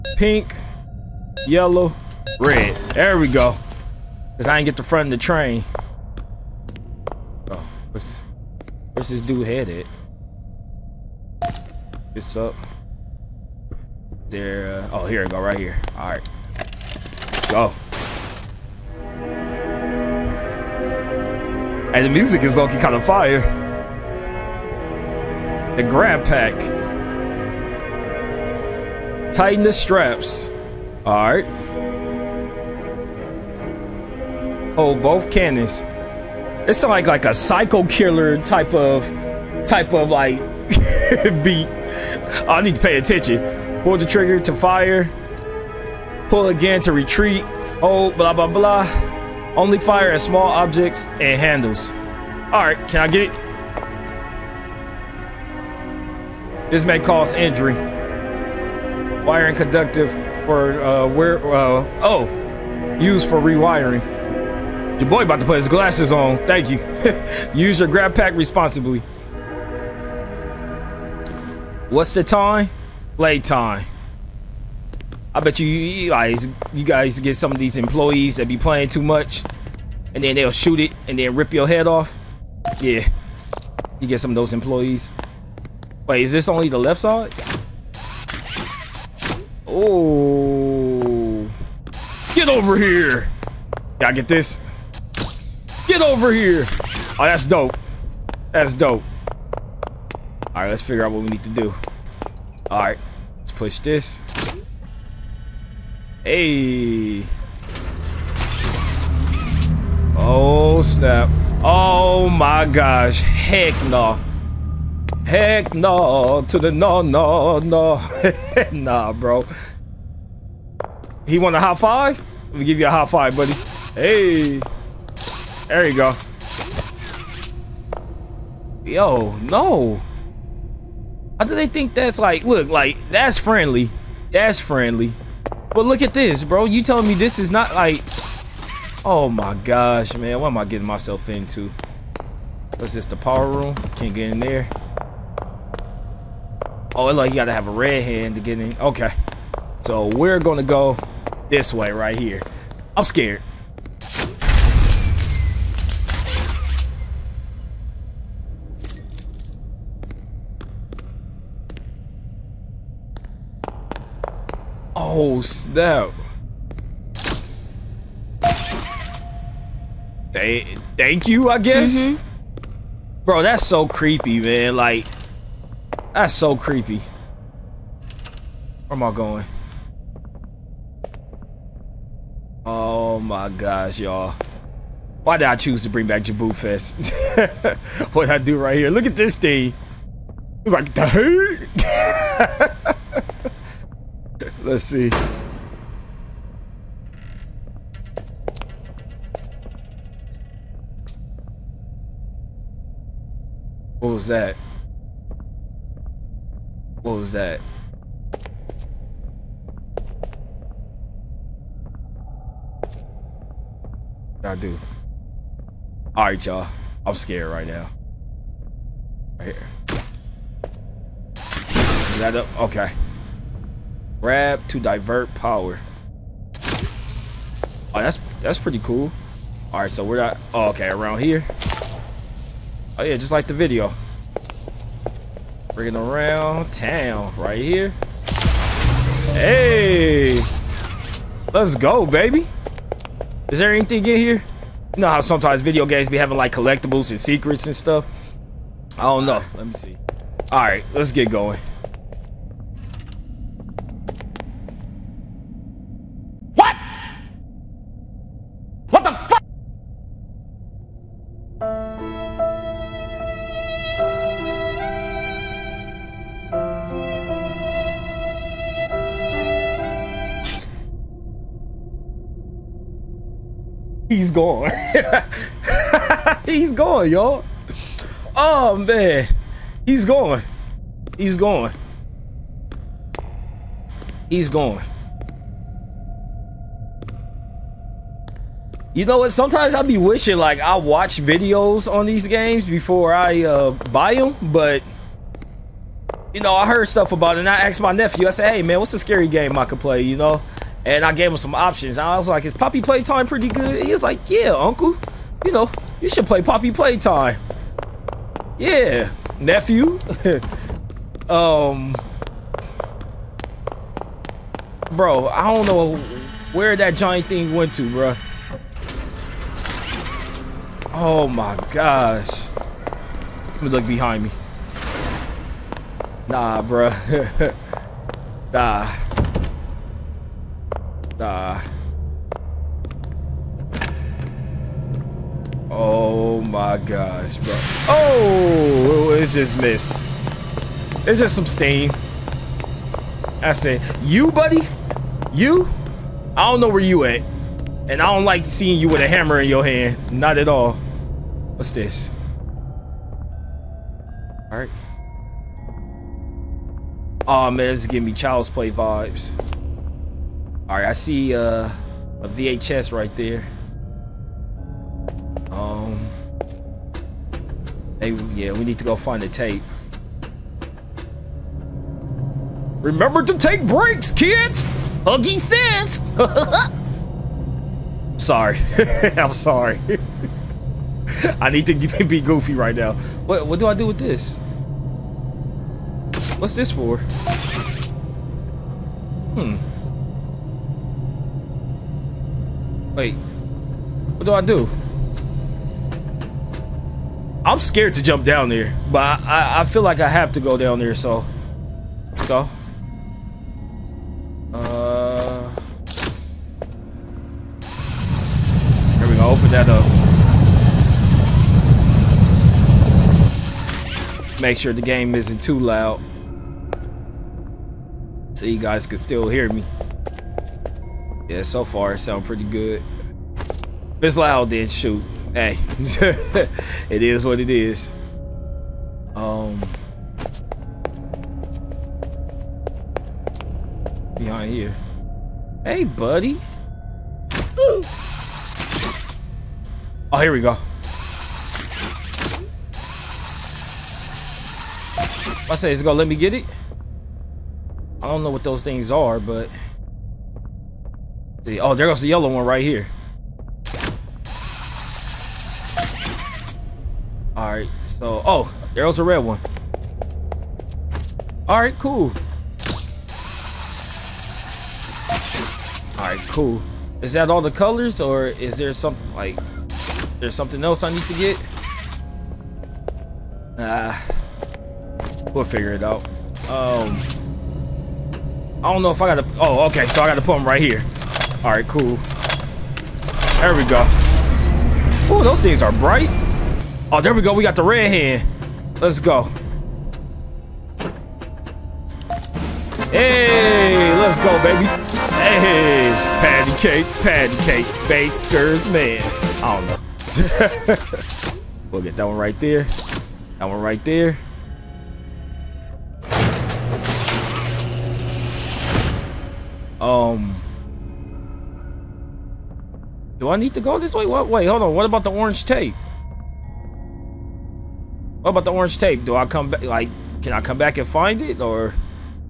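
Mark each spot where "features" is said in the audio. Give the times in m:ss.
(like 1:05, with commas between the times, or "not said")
not said.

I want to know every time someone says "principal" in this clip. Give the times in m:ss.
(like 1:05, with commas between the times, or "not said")
not said.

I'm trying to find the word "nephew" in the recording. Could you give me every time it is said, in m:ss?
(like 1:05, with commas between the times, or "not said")
4:57, 5:09.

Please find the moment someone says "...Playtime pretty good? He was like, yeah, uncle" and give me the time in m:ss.
5:02.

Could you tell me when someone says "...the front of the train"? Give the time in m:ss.
0:04.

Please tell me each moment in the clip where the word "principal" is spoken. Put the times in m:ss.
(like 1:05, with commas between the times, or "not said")
not said.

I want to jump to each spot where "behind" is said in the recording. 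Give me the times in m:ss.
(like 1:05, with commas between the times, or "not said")
5:23, 7:14.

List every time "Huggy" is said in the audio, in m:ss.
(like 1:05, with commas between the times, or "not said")
6:15.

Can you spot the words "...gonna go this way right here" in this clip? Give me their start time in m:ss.
2:30.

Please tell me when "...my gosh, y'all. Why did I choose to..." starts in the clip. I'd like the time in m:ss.
3:03.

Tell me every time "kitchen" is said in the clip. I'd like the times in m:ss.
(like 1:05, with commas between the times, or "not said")
not said.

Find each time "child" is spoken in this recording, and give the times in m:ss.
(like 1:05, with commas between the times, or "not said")
5:58.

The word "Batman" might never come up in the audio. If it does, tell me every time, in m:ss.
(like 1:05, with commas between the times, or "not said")
not said.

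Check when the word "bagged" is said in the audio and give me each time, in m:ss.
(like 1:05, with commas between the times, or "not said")
not said.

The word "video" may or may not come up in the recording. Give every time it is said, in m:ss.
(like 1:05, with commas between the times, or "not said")
3:53, 4:05, 4:51.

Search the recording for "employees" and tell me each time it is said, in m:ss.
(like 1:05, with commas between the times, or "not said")
1:17, 1:24.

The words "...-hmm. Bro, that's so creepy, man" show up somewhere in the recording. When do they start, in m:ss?
2:52.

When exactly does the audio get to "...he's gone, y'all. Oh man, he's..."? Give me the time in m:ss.
4:36.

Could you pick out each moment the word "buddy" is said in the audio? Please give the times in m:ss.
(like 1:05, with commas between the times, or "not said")
2:03, 5:44, 7:15.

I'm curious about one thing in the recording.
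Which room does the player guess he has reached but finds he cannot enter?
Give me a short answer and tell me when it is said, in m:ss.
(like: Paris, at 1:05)
The power room, at 2:23.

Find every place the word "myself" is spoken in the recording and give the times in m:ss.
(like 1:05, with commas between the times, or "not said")
2:20.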